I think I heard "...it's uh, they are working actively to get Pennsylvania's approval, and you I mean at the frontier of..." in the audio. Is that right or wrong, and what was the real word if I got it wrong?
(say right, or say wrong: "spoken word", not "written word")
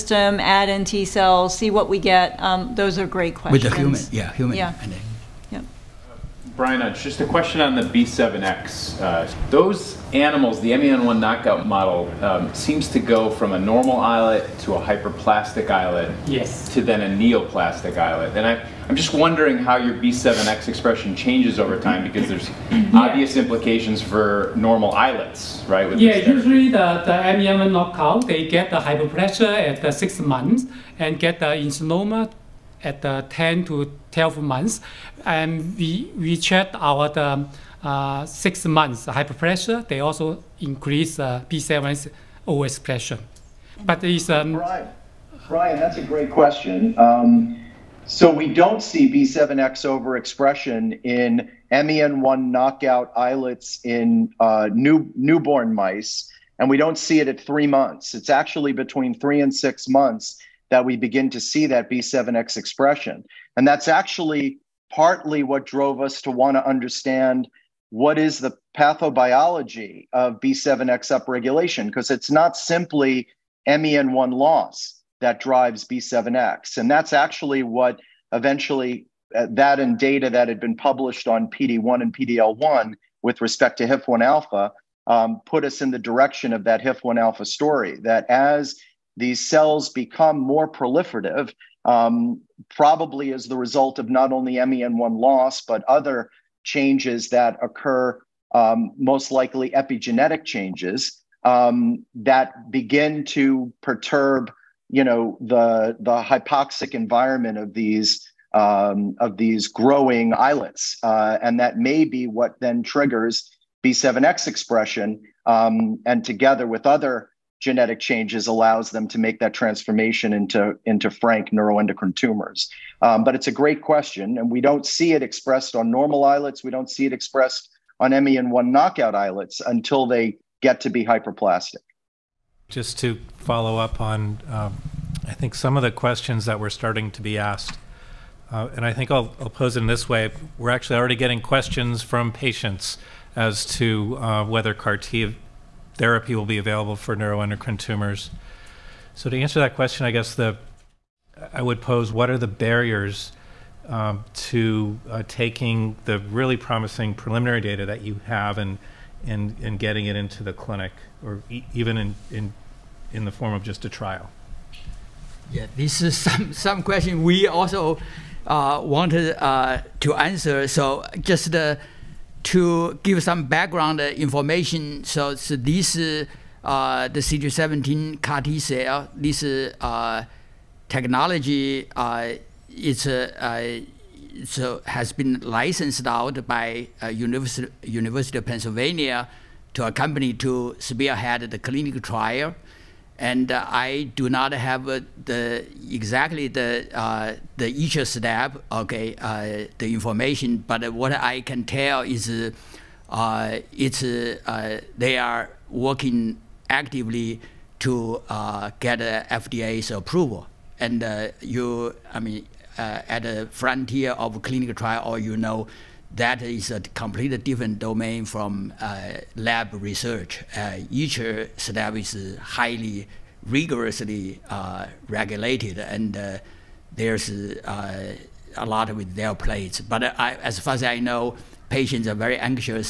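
wrong: "FDA", not "Pennsylvania".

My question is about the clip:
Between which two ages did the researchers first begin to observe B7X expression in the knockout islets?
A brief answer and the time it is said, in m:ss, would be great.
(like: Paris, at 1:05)
3 and 6 months, at 0:58.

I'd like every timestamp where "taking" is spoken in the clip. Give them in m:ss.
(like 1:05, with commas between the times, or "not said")
2:35.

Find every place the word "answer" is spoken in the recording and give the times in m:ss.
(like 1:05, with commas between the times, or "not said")
2:29, 2:50.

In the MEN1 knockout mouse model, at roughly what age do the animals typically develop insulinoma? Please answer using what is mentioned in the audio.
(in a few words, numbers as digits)
10 to 12 months.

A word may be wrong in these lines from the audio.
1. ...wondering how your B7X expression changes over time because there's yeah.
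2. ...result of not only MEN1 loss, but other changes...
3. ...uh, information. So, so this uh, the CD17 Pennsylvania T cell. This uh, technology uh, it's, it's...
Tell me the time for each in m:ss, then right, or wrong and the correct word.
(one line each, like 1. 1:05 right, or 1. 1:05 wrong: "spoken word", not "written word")
1. 0:19 right
2. 1:33 right
3. 2:53 wrong: "CAR", not "Pennsylvania".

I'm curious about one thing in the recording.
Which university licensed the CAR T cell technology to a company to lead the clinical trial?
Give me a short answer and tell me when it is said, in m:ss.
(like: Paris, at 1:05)
University of Pennsylvania, at 3:07.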